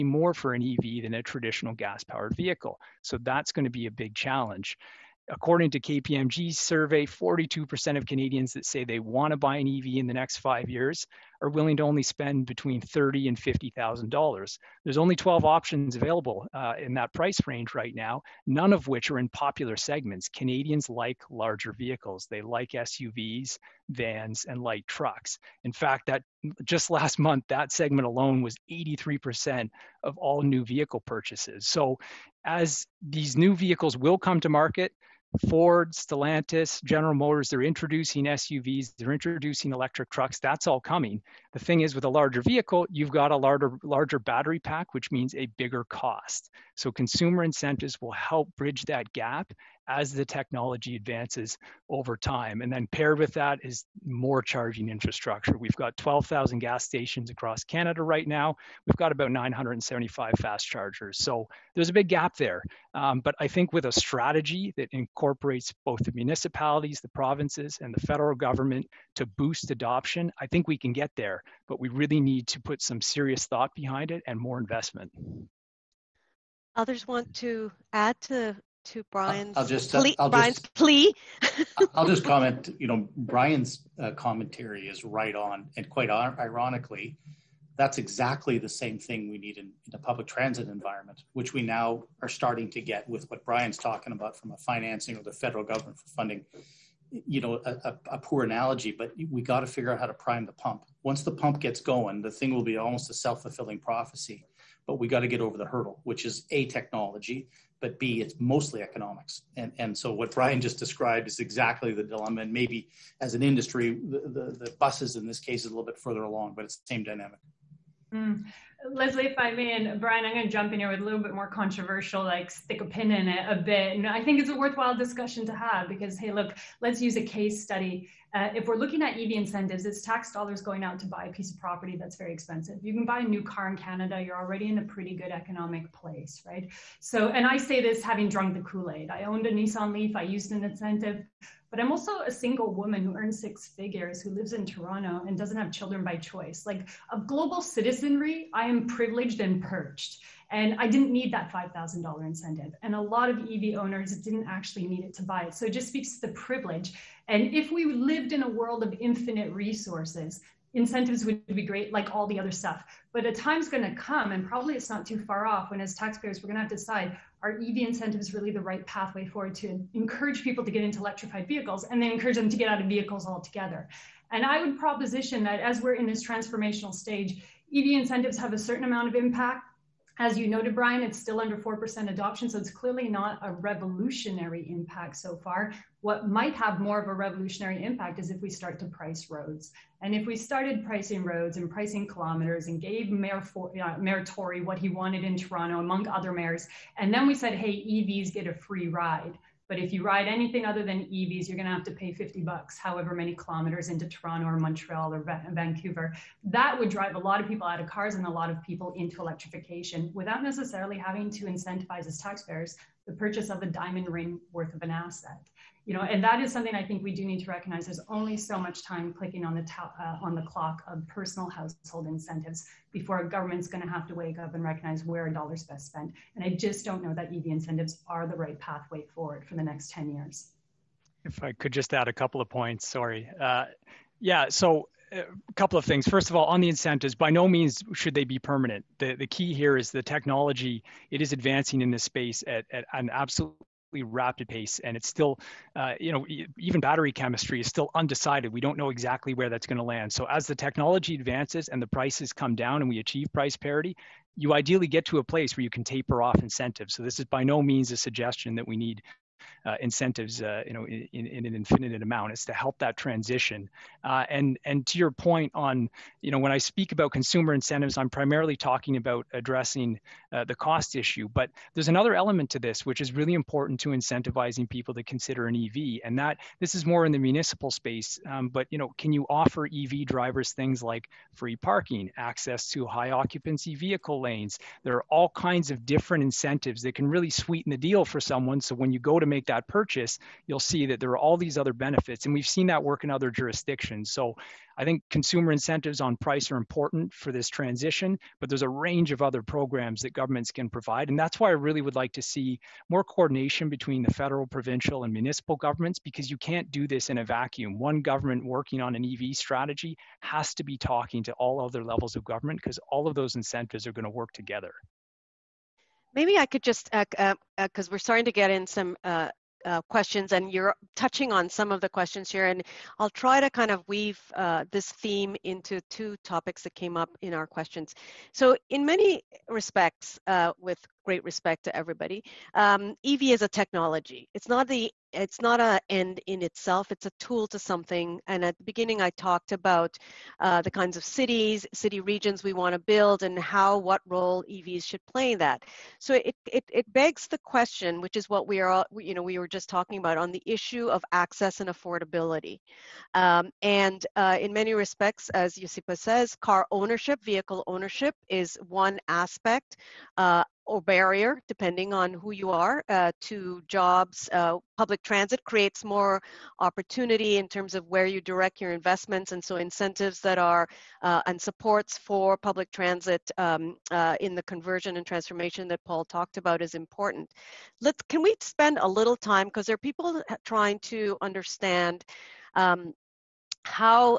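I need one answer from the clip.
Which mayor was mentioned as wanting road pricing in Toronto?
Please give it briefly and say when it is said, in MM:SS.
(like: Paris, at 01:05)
Mayor Tory, at 03:13.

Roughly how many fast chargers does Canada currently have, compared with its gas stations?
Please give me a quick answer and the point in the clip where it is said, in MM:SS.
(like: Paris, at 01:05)
975, at 00:59.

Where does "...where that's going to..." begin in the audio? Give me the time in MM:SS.
04:09.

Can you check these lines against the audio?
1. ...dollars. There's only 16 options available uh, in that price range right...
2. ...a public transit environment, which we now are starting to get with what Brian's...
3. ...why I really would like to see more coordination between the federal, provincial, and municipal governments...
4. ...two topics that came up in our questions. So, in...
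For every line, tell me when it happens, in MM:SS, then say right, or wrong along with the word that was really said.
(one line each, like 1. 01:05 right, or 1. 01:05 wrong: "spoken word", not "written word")
1. 00:14 wrong: "12", not "16"
2. 01:29 right
3. 05:01 right
4. 05:25 right.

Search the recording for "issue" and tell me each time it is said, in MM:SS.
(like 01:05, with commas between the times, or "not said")
04:30, 05:50.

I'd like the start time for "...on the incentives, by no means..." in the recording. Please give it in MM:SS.
03:56.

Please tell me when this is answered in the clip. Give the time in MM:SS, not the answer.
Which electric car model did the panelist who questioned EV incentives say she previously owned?
02:19.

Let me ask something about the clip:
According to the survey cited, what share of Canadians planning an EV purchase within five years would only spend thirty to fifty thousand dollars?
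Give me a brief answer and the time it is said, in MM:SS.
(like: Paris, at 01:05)
42%, at 00:07.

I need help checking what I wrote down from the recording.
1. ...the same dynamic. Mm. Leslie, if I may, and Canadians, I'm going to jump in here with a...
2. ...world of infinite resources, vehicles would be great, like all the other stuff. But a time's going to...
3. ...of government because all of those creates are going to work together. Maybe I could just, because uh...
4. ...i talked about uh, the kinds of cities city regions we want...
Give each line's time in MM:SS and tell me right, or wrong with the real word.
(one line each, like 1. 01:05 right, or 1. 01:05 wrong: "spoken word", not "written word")
1. 01:56 wrong: "Brian", not "Canadians"
2. 02:38 wrong: "incentives", not "vehicles"
3. 05:12 wrong: "incentives", not "creates"
4. 05:39 right.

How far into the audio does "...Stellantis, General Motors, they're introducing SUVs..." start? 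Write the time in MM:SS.
00:35.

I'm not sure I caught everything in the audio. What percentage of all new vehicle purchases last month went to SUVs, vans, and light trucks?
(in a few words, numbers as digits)
83%.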